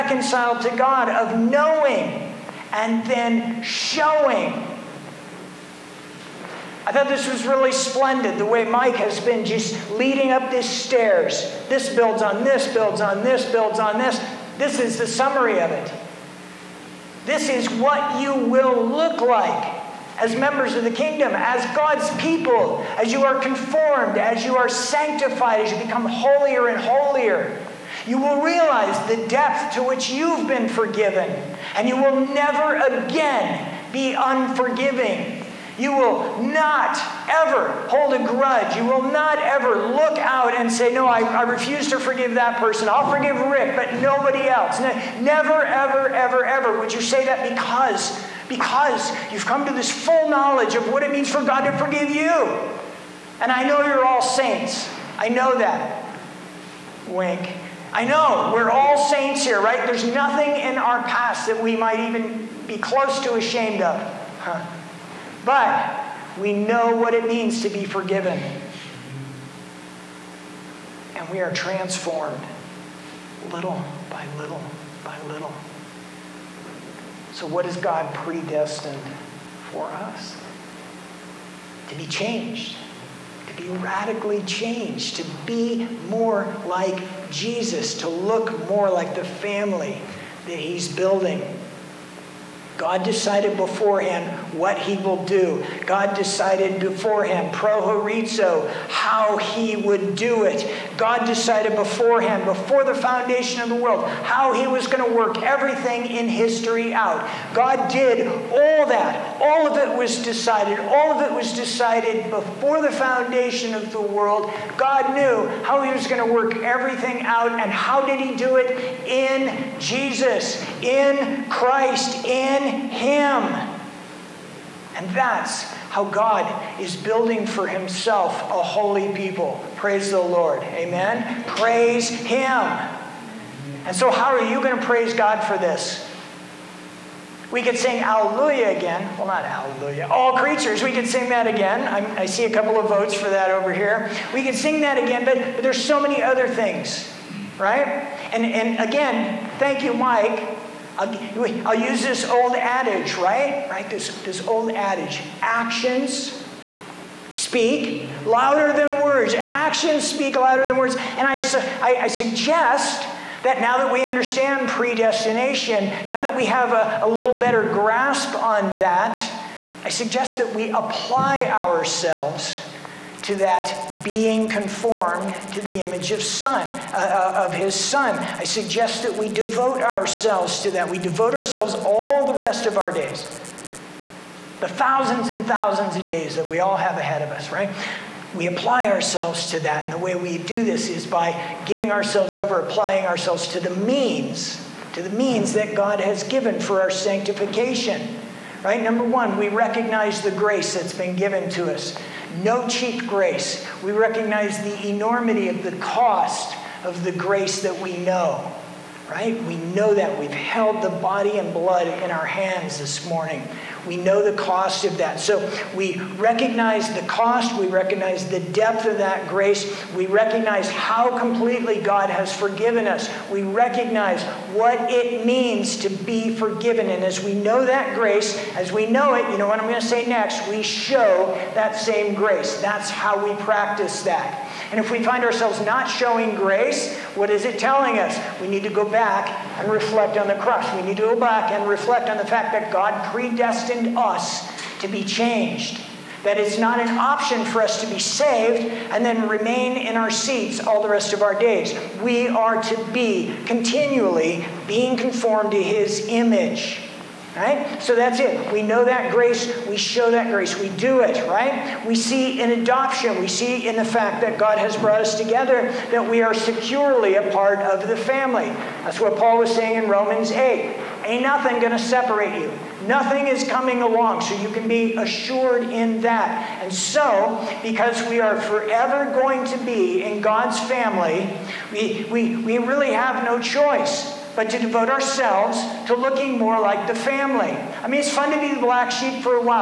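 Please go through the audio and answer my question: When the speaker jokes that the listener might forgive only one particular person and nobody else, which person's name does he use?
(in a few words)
Rick.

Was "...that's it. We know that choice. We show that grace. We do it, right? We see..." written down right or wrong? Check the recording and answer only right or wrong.
wrong.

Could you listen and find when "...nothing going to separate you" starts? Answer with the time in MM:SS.
04:31.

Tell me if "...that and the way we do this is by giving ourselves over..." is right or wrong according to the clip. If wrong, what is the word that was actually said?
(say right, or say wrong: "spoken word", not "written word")
right.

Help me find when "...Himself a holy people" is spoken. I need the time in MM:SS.
02:07.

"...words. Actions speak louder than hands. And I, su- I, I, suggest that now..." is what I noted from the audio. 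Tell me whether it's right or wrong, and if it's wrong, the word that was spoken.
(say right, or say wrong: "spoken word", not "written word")
wrong: "words", not "hands".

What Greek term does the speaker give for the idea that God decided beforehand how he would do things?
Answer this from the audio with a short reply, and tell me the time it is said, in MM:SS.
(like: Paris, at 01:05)
prohorizo, at 01:37.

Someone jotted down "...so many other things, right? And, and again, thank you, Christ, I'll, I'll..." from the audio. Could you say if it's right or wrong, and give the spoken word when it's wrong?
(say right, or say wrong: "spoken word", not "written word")
wrong: "Mike", not "Christ".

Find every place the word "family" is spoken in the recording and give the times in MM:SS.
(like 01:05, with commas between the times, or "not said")
01:29, 04:27, 04:40, 04:46.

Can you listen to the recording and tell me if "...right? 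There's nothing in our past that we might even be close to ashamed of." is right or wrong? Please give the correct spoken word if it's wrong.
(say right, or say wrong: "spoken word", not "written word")
right.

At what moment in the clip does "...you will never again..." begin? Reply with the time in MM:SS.
00:31.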